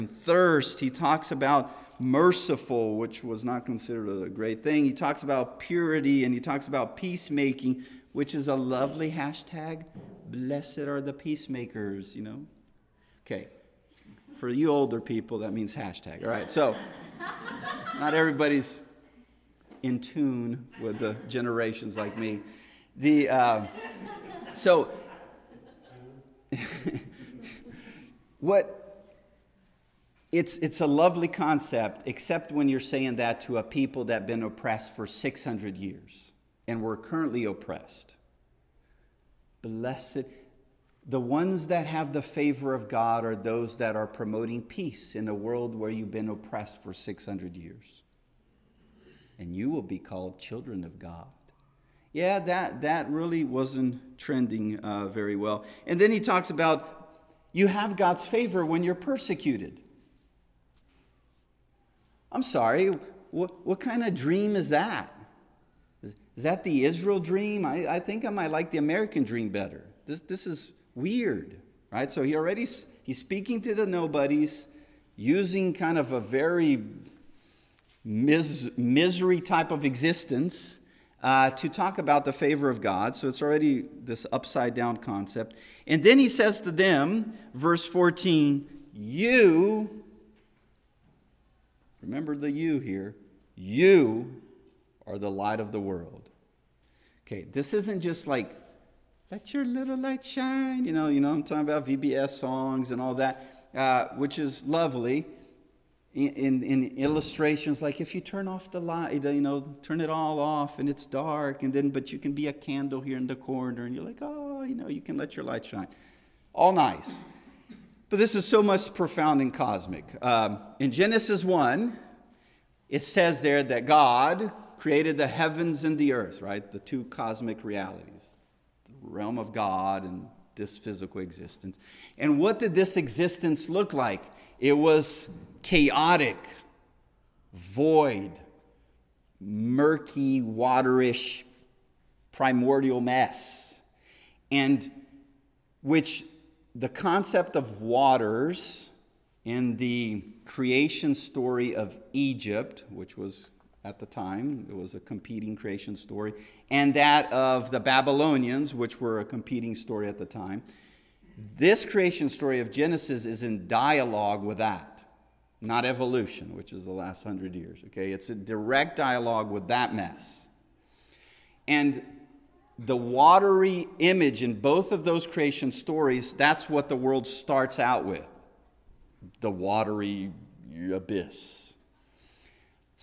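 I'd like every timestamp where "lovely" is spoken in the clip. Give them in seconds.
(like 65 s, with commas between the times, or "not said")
8 s, 30 s, 104 s.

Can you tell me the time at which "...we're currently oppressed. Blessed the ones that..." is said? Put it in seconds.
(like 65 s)
36 s.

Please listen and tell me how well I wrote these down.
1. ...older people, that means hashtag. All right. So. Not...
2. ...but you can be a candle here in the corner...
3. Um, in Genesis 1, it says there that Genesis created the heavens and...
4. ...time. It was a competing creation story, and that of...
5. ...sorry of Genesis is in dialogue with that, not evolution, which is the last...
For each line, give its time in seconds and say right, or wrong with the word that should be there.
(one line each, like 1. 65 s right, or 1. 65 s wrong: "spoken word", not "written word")
1. 14 s right
2. 111 s right
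3. 120 s wrong: "God", not "Genesis"
4. 154 s right
5. 162 s wrong: "story", not "sorry".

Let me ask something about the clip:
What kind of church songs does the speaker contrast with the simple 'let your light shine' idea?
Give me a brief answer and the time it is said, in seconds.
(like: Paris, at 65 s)
VBS songs, at 101 s.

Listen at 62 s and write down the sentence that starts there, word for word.
I'm sorry, what, what kind of dream is that?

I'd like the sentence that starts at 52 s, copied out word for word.
Yeah, that, that really wasn't trending uh, very well.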